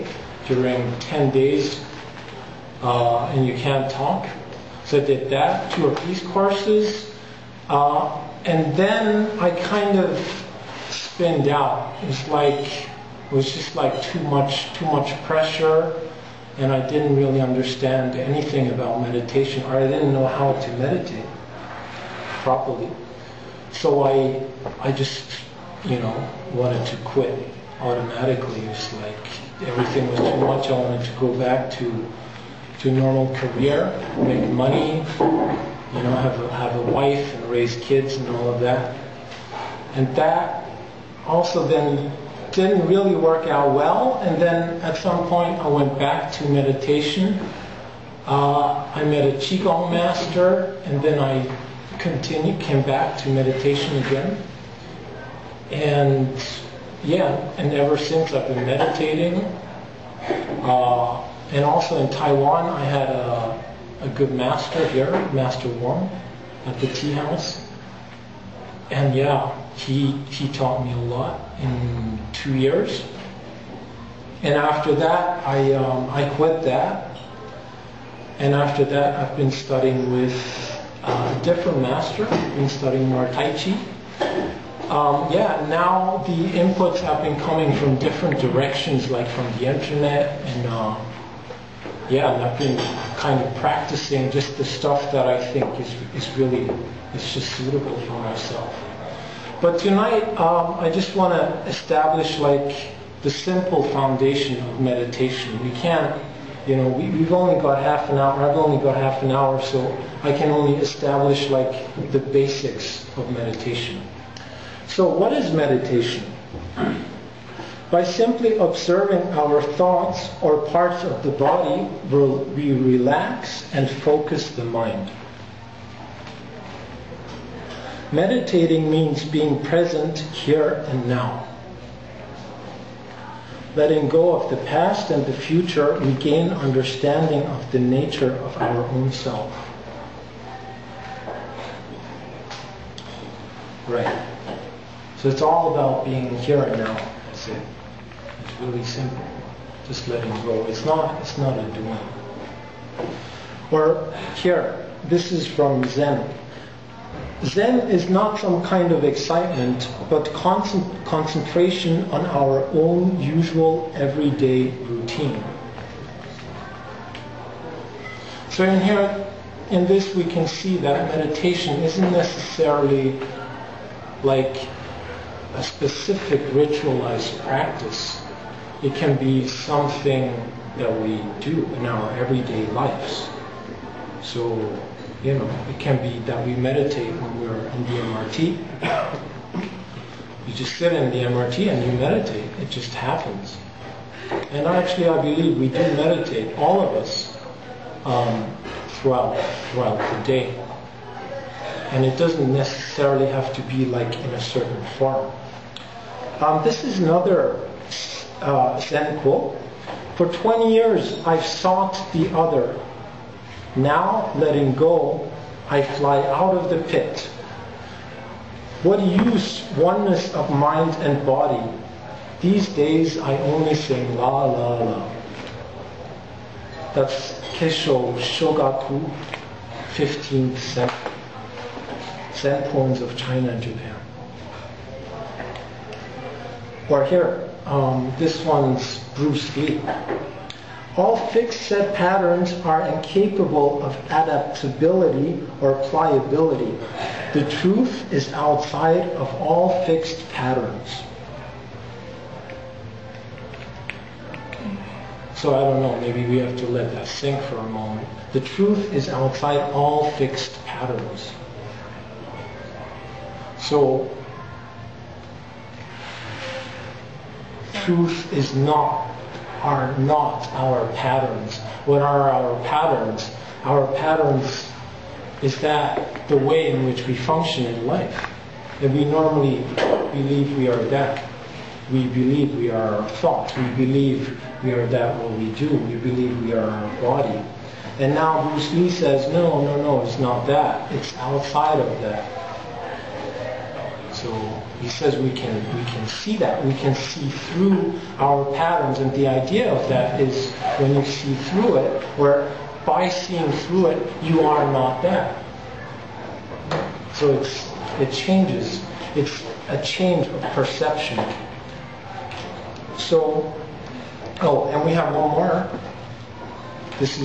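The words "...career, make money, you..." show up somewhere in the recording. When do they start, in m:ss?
0:33.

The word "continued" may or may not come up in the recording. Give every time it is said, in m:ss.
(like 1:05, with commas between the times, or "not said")
0:51.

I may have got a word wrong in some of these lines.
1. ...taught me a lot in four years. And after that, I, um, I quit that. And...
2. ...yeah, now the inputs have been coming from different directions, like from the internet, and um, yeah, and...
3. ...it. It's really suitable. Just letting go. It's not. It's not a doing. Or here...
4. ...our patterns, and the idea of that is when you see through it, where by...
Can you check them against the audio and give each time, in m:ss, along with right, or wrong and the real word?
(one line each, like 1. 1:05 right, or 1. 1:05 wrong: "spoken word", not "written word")
1. 1:10 wrong: "two", not "four"
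2. 1:25 right
3. 2:27 wrong: "simple", not "suitable"
4. 4:58 right.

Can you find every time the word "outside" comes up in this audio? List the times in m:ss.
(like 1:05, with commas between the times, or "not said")
4:08, 4:19, 4:51.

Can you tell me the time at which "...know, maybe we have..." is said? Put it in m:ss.
4:15.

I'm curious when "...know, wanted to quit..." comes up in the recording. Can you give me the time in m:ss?
0:25.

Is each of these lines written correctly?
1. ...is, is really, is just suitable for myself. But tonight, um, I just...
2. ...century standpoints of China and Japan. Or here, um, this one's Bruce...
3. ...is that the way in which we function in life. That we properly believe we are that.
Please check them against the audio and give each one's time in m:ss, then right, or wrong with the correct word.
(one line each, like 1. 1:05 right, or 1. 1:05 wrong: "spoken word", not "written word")
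1. 1:35 right
2. 3:50 right
3. 4:35 wrong: "normally", not "properly".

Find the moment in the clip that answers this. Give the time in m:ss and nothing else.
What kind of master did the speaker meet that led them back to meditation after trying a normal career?
0:49.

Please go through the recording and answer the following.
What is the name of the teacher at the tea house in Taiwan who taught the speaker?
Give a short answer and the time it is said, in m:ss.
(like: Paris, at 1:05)
Master Wong, at 1:05.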